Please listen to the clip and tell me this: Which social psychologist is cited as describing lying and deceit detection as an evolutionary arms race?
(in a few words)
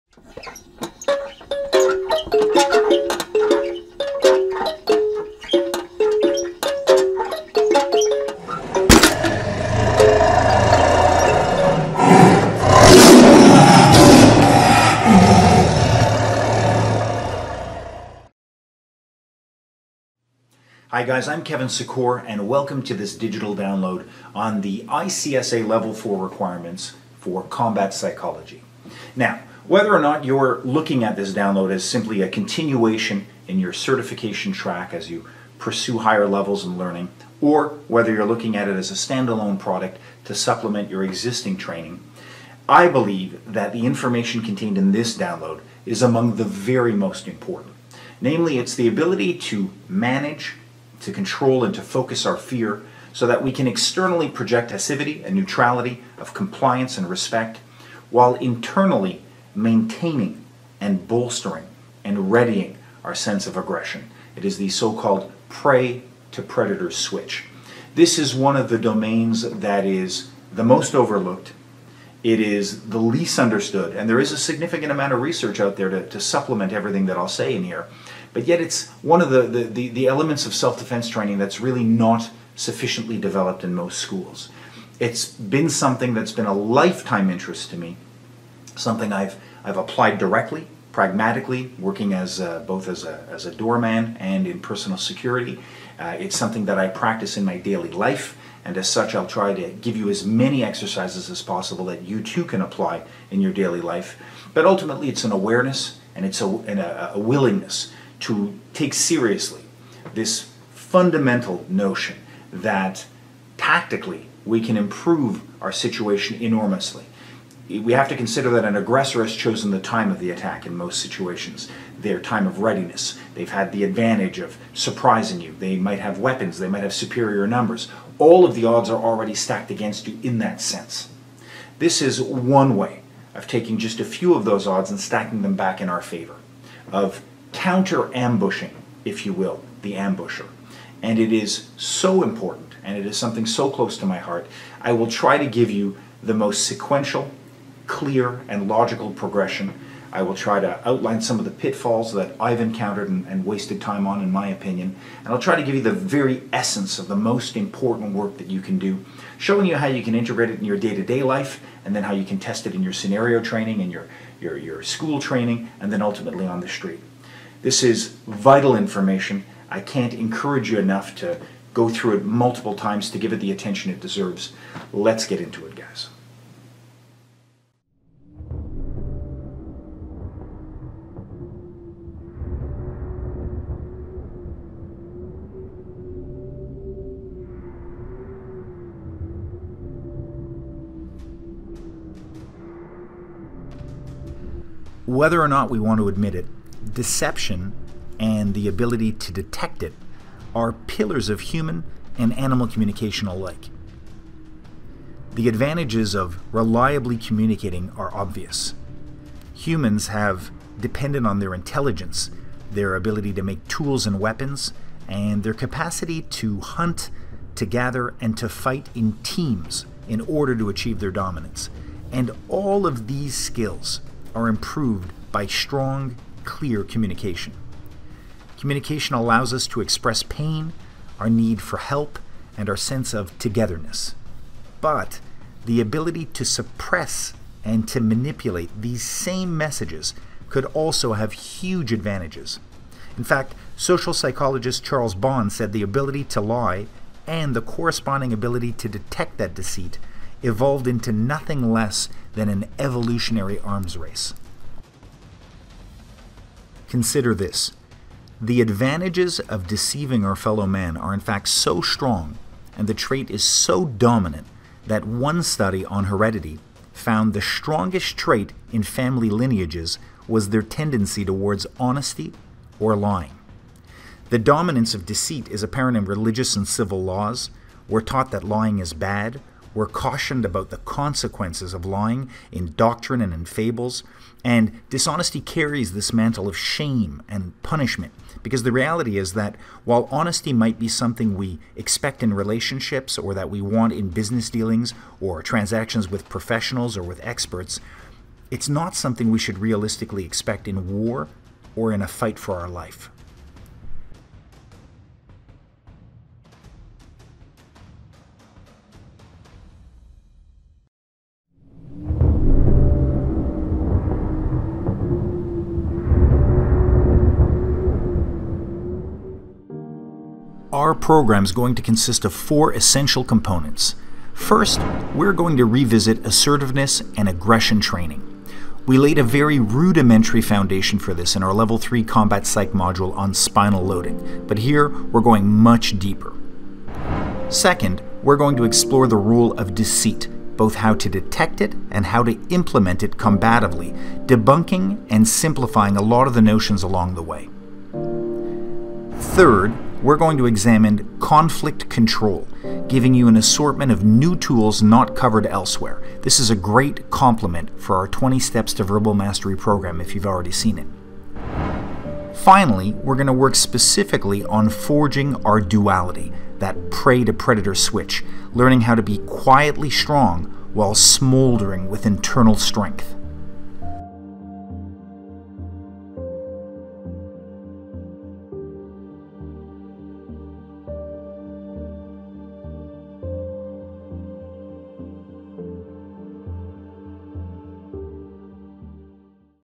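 Charles Bond.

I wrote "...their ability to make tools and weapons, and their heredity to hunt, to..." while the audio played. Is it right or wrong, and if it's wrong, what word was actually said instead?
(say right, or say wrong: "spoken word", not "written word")
wrong: "capacity", not "heredity".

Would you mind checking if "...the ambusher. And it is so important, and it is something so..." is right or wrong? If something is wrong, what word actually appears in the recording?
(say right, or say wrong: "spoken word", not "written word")
right.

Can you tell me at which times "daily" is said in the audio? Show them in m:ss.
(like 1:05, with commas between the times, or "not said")
1:37, 1:43.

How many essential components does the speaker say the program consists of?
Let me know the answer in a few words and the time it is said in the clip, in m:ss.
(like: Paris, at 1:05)
4, at 5:22.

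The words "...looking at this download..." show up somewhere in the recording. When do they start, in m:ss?
0:30.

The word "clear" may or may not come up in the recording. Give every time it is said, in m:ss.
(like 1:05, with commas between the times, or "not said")
2:27, 3:46.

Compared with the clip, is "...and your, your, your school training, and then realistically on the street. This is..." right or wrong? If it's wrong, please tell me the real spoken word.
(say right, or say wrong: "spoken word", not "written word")
wrong: "ultimately", not "realistically".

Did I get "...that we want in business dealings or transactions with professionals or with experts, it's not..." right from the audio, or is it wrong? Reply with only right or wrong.
right.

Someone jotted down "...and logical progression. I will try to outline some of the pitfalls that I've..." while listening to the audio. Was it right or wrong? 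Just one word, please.
right.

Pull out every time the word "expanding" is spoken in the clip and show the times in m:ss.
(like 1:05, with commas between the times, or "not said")
not said.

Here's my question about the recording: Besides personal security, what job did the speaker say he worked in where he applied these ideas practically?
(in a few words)
Doorman.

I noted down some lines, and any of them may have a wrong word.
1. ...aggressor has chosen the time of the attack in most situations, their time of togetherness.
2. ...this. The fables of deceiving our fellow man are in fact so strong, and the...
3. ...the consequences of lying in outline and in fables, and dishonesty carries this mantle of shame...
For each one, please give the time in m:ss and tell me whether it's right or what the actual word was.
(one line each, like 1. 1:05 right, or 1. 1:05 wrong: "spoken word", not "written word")
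1. 1:58 wrong: "readiness", not "togetherness"
2. 4:17 wrong: "advantages", not "fables"
3. 4:40 wrong: "doctrine", not "outline".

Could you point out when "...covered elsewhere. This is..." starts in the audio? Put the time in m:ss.
5:55.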